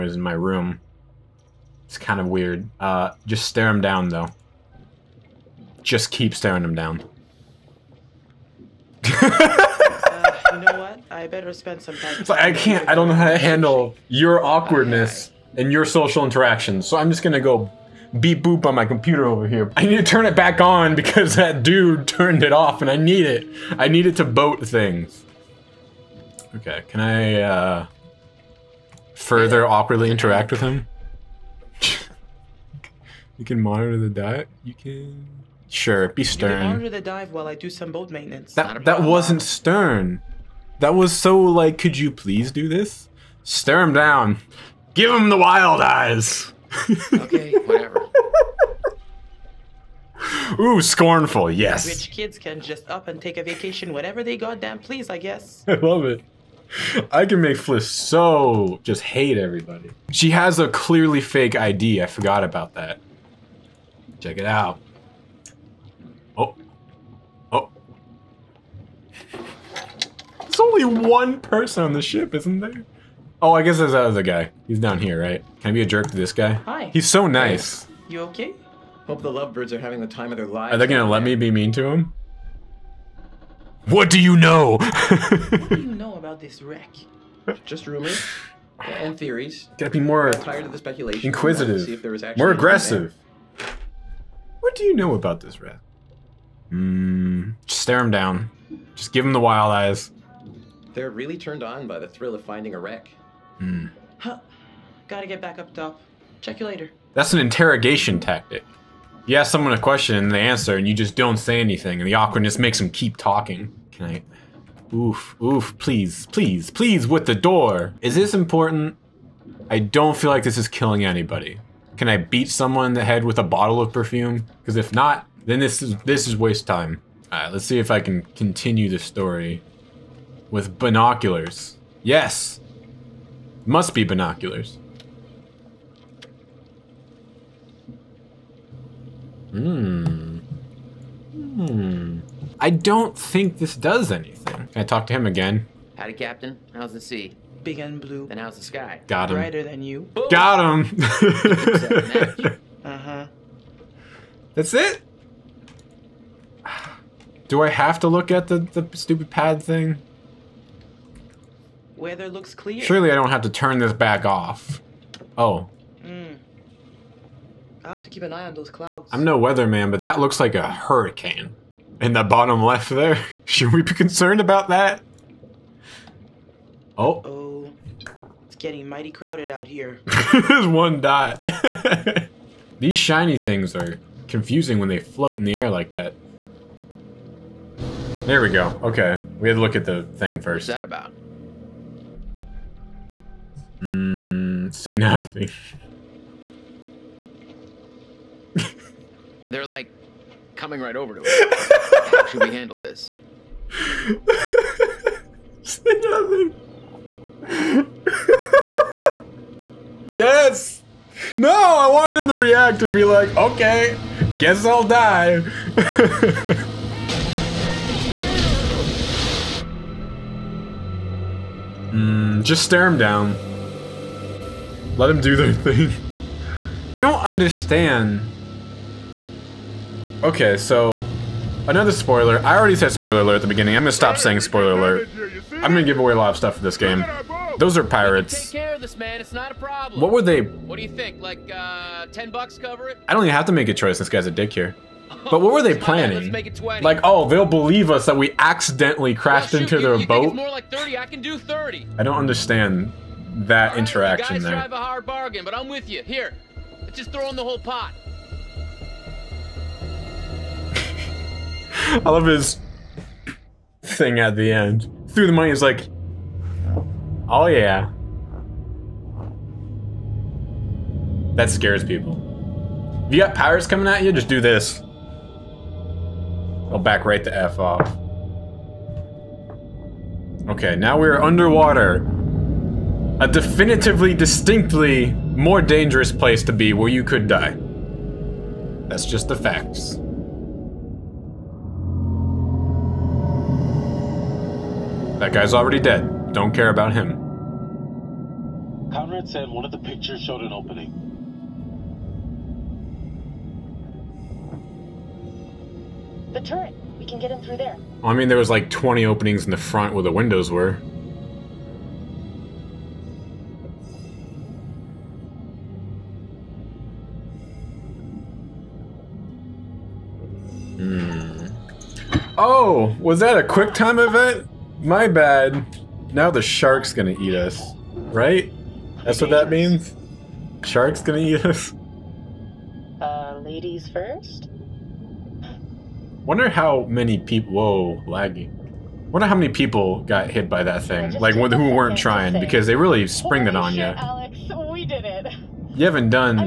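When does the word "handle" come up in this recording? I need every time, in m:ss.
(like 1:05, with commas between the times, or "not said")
0:13, 3:22.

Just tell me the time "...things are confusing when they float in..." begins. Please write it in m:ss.
3:03.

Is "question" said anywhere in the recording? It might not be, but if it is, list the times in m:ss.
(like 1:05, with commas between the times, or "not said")
1:49.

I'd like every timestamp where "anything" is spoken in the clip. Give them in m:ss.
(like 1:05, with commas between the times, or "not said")
1:51, 2:24.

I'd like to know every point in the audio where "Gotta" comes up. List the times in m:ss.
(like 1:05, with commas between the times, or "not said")
1:29, 1:45.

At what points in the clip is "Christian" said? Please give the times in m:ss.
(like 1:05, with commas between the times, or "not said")
not said.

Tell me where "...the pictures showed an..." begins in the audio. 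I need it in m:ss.
4:59.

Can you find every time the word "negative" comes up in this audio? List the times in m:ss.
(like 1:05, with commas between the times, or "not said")
not said.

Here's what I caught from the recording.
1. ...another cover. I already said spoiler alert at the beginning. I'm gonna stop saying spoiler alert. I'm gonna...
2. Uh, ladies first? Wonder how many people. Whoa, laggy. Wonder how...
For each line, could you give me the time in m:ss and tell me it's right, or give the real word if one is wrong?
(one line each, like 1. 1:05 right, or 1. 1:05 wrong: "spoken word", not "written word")
1. 3:51 wrong: "spoiler", not "cover"
2. 5:32 right.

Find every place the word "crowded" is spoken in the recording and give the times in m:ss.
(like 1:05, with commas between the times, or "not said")
2:59.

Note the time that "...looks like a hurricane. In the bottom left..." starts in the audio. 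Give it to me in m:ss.
2:50.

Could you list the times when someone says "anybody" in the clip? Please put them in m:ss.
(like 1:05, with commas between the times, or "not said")
2:01.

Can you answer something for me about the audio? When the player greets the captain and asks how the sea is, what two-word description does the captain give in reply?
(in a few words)
Big and blue.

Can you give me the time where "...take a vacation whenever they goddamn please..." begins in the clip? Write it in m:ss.
0:53.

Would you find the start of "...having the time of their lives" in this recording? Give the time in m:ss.
1:19.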